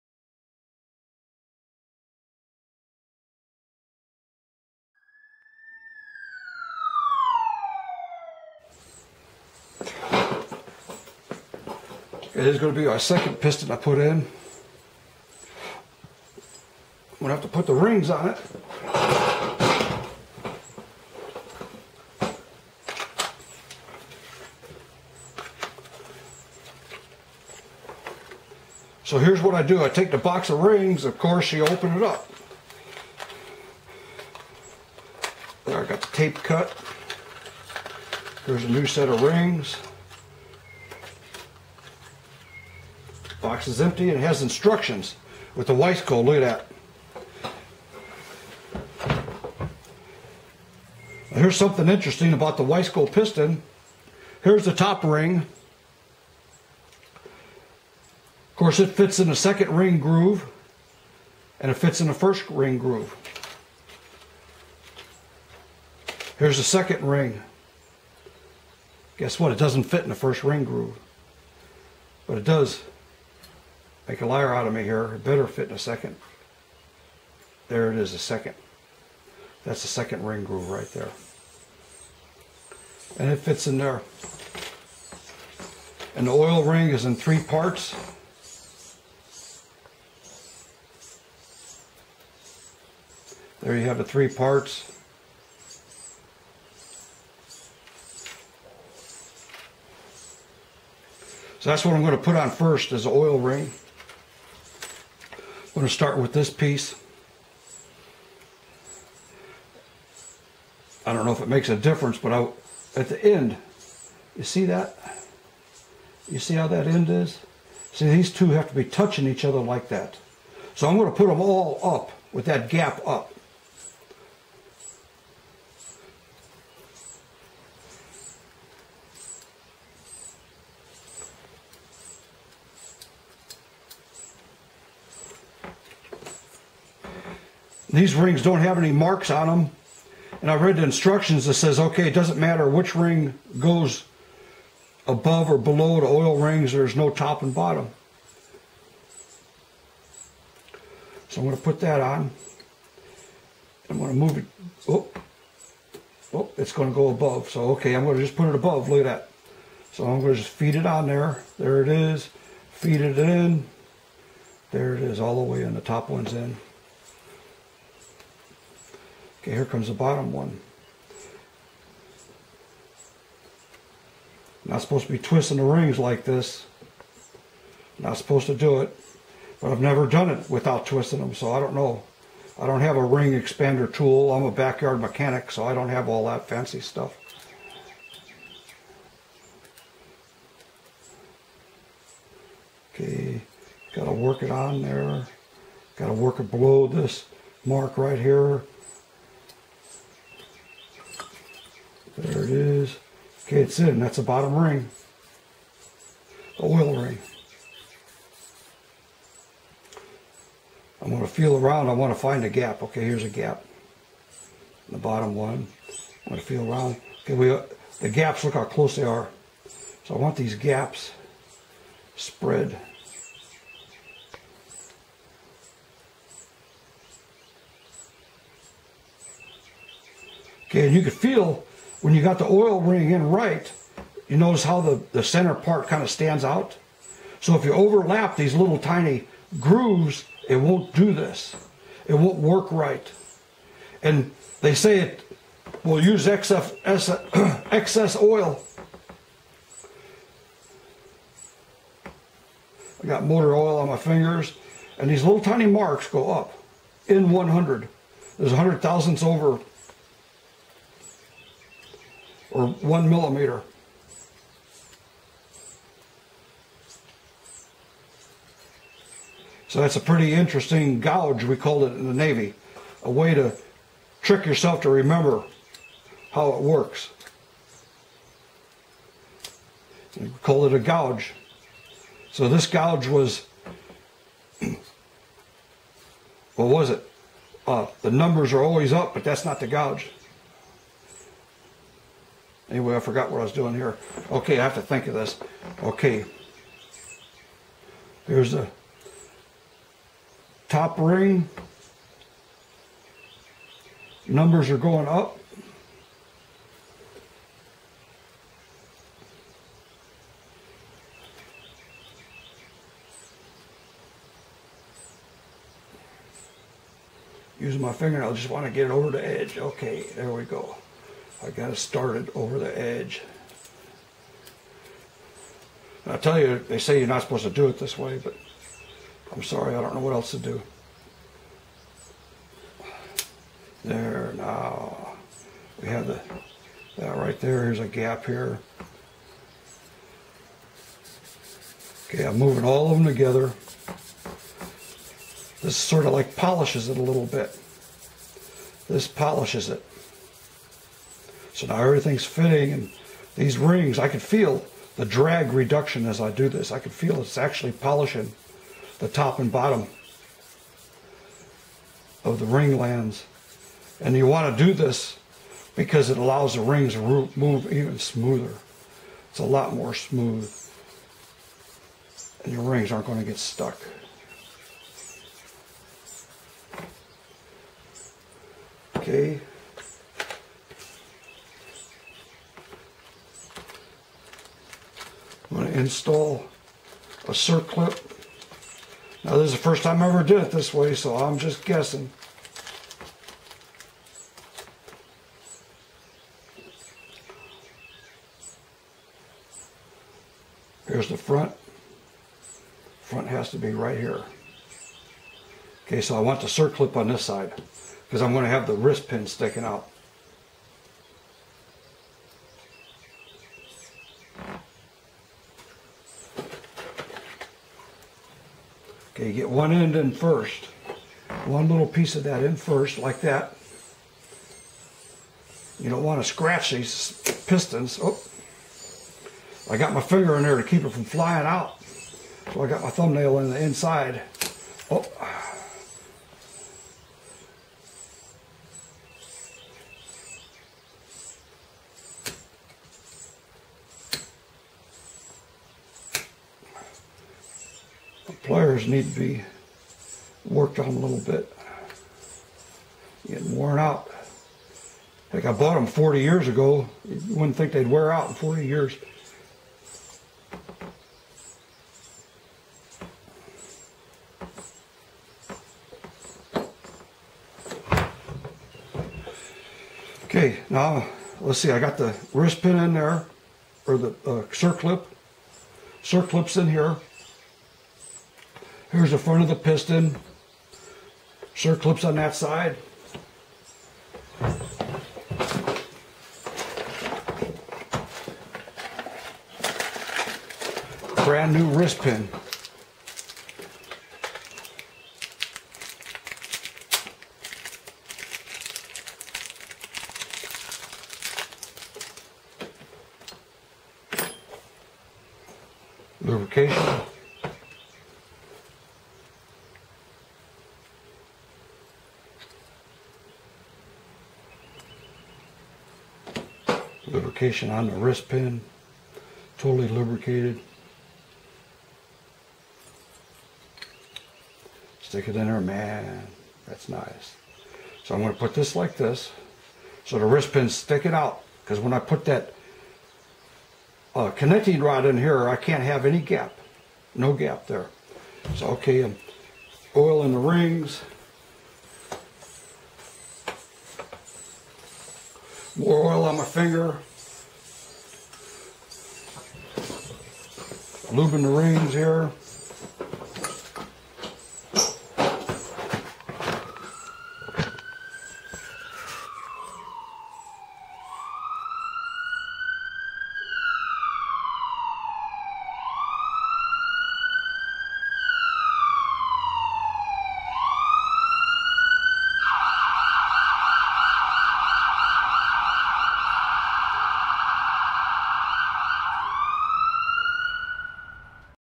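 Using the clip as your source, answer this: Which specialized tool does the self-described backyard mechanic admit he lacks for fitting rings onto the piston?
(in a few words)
ring expander tool.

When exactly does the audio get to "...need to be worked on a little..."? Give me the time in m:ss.
7:28.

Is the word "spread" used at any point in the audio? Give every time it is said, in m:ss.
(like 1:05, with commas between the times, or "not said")
3:42.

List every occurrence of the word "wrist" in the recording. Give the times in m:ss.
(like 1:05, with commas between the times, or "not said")
6:48, 7:52, 8:11, 8:37, 8:50.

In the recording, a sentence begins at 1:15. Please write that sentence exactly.
It better fit in a second.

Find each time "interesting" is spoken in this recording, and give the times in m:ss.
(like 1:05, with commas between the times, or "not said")
0:51, 4:30.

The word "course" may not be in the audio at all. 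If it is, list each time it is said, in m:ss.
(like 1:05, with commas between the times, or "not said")
0:31, 0:58.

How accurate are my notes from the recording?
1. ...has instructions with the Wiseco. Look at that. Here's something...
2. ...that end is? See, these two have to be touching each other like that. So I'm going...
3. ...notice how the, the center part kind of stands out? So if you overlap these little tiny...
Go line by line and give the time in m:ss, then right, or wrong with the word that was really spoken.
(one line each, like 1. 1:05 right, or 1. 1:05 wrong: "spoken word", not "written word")
1. 0:44 right
2. 1:56 right
3. 3:54 right.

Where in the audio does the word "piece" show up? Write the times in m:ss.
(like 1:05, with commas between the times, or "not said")
1:46, 7:01.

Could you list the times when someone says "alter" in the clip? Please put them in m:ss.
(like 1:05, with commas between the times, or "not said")
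not said.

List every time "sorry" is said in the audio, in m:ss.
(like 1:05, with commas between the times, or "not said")
5:29.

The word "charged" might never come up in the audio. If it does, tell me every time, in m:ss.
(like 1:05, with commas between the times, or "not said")
not said.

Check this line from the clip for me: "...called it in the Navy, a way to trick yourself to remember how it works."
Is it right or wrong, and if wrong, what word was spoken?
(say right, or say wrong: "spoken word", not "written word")
right.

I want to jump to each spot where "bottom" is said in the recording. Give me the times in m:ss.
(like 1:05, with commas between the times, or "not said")
2:27, 2:49, 3:24, 3:34, 5:59.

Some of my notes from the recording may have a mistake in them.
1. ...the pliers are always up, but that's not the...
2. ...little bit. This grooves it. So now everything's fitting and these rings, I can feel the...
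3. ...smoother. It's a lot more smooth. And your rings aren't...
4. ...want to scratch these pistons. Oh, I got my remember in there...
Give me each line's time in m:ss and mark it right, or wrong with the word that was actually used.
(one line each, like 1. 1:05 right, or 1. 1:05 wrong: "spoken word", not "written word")
1. 4:48 wrong: "numbers", not "pliers"
2. 5:47 wrong: "polishes", not "grooves"
3. 6:07 right
4. 7:06 wrong: "finger", not "remember".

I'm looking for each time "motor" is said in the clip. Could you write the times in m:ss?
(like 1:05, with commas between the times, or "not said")
4:13.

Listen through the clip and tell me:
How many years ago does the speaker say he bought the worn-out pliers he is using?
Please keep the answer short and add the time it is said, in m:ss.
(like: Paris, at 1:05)
40, at 7:35.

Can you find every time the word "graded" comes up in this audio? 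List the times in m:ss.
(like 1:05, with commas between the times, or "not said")
not said.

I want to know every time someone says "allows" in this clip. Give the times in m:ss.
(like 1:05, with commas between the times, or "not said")
6:06.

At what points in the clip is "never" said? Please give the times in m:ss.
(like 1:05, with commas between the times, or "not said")
2:59.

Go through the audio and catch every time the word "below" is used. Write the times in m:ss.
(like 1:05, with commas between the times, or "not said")
2:25, 3:16.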